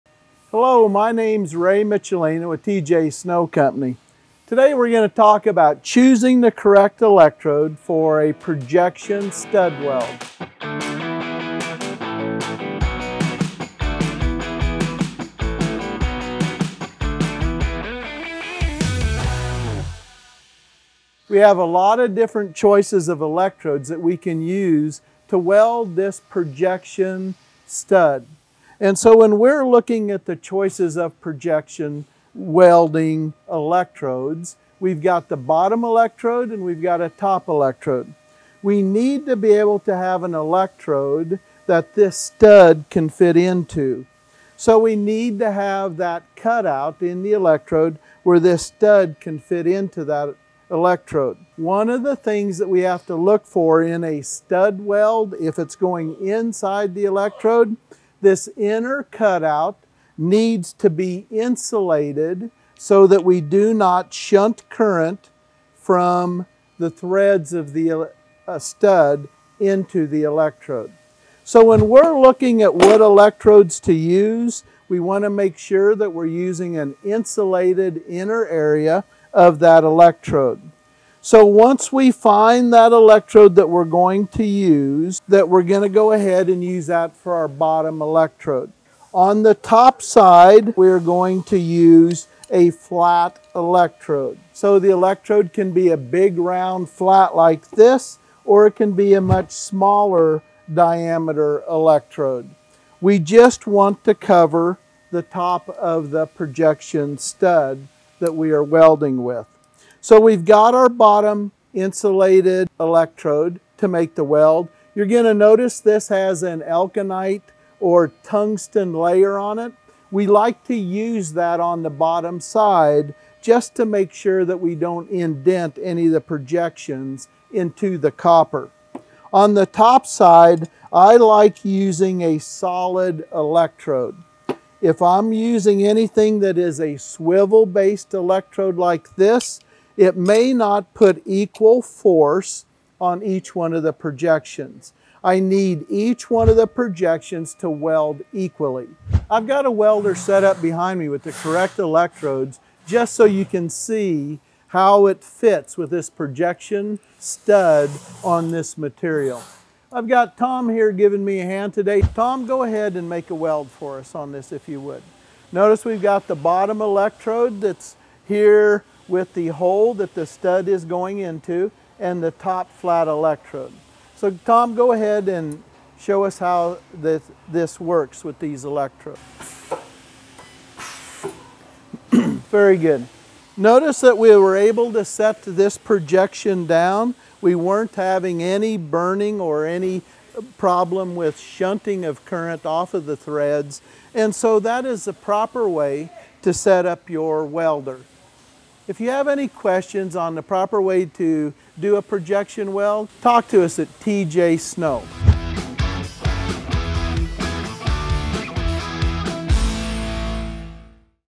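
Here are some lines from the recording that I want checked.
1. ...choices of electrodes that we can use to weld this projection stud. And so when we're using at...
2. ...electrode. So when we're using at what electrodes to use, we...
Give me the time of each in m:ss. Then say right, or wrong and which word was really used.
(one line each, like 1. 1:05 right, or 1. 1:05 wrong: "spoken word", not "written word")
1. 0:22 wrong: "looking", not "using"
2. 1:10 wrong: "looking", not "using".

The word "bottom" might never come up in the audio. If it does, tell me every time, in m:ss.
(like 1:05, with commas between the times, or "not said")
0:35, 1:27, 1:50, 2:01, 2:46.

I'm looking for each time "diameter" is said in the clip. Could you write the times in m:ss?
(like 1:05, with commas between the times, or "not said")
1:40.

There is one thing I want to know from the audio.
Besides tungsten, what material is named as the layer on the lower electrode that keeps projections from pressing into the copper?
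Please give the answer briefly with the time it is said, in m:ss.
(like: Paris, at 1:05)
Elkonite, at 1:56.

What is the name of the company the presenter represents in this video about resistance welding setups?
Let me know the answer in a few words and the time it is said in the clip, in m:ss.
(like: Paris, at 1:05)
TJ Snow Company, at 0:02.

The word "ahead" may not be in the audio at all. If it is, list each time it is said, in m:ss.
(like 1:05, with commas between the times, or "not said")
1:26, 2:42, 2:54.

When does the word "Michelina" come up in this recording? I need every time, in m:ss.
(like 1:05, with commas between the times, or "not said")
0:01.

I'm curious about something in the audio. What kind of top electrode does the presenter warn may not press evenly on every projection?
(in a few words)
Swivel-based electrode.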